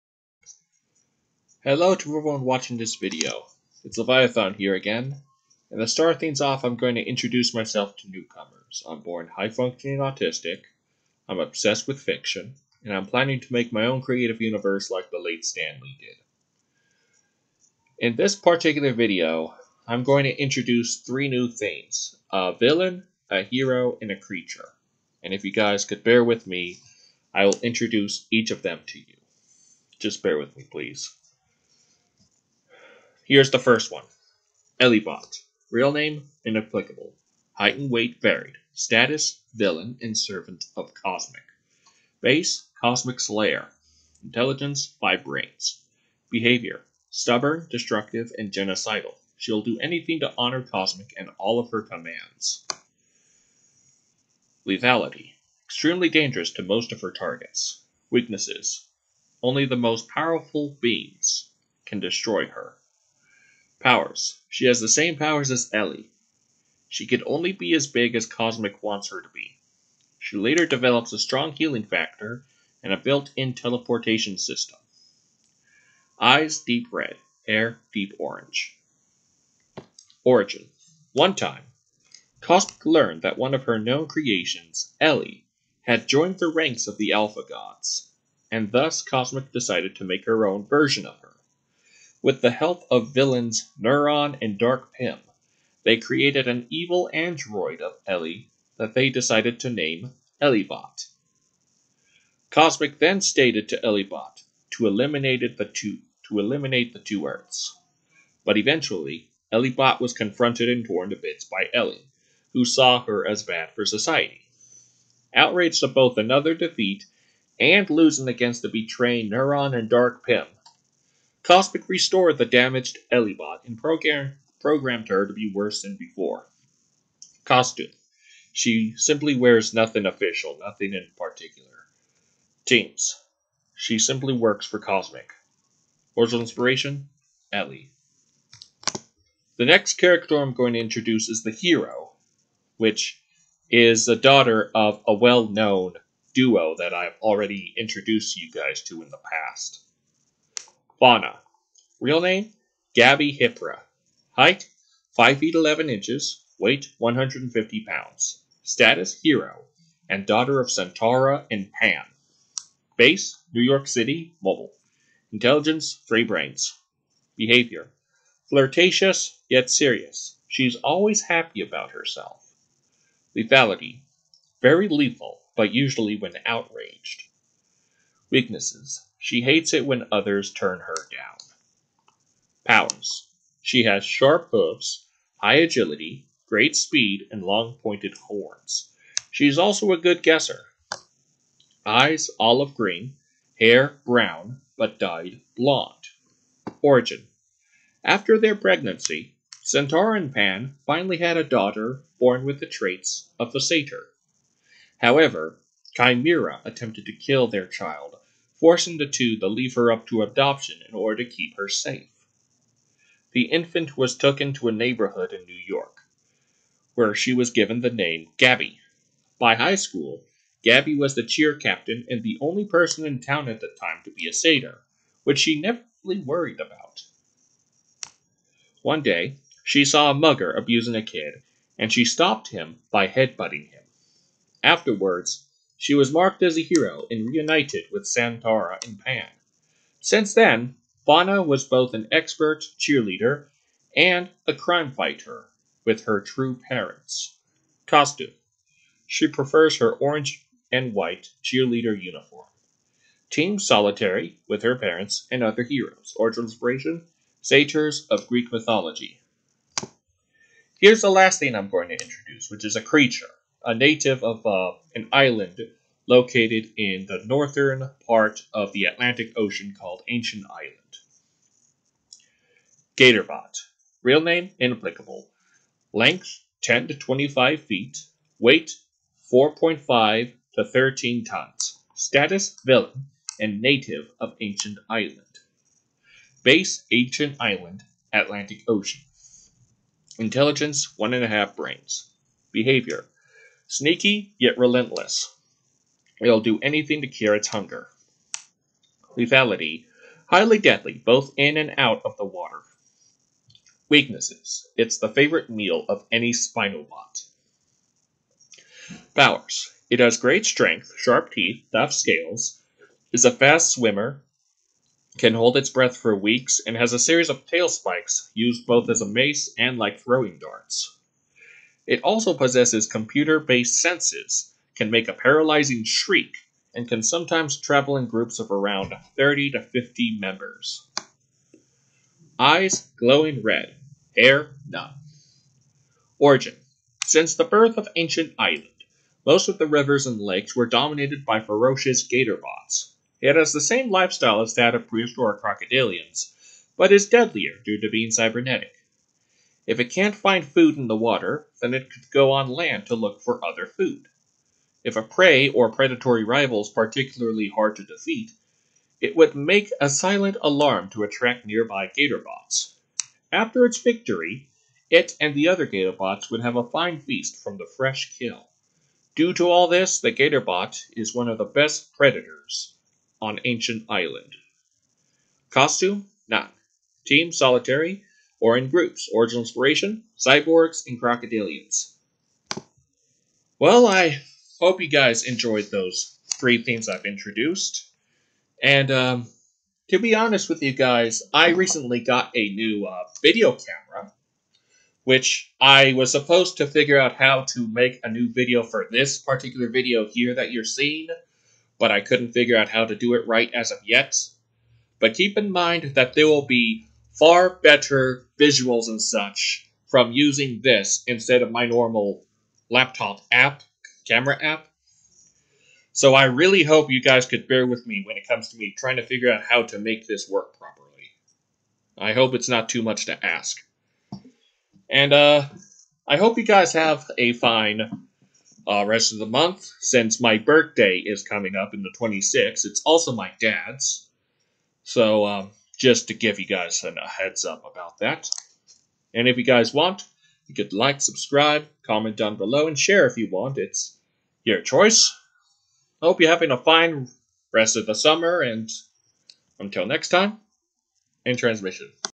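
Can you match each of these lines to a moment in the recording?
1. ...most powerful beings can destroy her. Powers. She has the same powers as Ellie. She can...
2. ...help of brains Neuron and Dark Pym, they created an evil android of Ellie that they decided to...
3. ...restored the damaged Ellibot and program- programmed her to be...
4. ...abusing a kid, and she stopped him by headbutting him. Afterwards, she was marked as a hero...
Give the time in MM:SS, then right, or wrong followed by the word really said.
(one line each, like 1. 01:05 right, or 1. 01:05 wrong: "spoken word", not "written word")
1. 00:59 right
2. 01:32 wrong: "villains", not "brains"
3. 02:01 right
4. 03:50 right.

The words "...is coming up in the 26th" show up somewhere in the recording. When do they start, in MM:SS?
07:11.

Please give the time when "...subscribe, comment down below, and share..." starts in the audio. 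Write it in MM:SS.
07:21.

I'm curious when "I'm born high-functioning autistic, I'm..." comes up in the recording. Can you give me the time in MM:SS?
00:08.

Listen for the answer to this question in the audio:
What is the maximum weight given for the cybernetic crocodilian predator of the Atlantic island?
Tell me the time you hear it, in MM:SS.
04:40.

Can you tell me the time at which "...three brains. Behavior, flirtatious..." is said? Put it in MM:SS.
02:46.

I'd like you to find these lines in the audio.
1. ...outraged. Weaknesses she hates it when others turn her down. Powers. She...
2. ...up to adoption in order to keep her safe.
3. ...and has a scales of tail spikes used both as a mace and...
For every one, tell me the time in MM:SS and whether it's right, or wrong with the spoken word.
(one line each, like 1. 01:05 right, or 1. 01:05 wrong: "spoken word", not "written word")
1. 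02:56 right
2. 03:29 right
3. 05:16 wrong: "series", not "scales".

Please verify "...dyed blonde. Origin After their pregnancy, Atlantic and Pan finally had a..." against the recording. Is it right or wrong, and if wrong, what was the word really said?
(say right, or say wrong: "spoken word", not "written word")
wrong: "Centaura", not "Atlantic".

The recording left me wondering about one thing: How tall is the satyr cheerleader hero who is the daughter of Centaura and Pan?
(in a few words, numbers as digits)
5 feet 11 inches.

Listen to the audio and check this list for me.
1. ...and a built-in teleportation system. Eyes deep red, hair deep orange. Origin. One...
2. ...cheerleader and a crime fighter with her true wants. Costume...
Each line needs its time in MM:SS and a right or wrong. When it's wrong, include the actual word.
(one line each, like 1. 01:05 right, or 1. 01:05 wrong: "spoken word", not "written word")
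1. 01:12 right
2. 04:02 wrong: "parents", not "wants".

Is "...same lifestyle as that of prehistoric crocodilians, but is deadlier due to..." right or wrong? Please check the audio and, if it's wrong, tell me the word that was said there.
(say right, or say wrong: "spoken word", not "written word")
right.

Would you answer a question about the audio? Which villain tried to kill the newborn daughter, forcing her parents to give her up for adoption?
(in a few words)
Chimera.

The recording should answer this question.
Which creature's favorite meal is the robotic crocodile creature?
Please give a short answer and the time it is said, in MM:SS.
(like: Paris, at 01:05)
Spinobot, at 05:06.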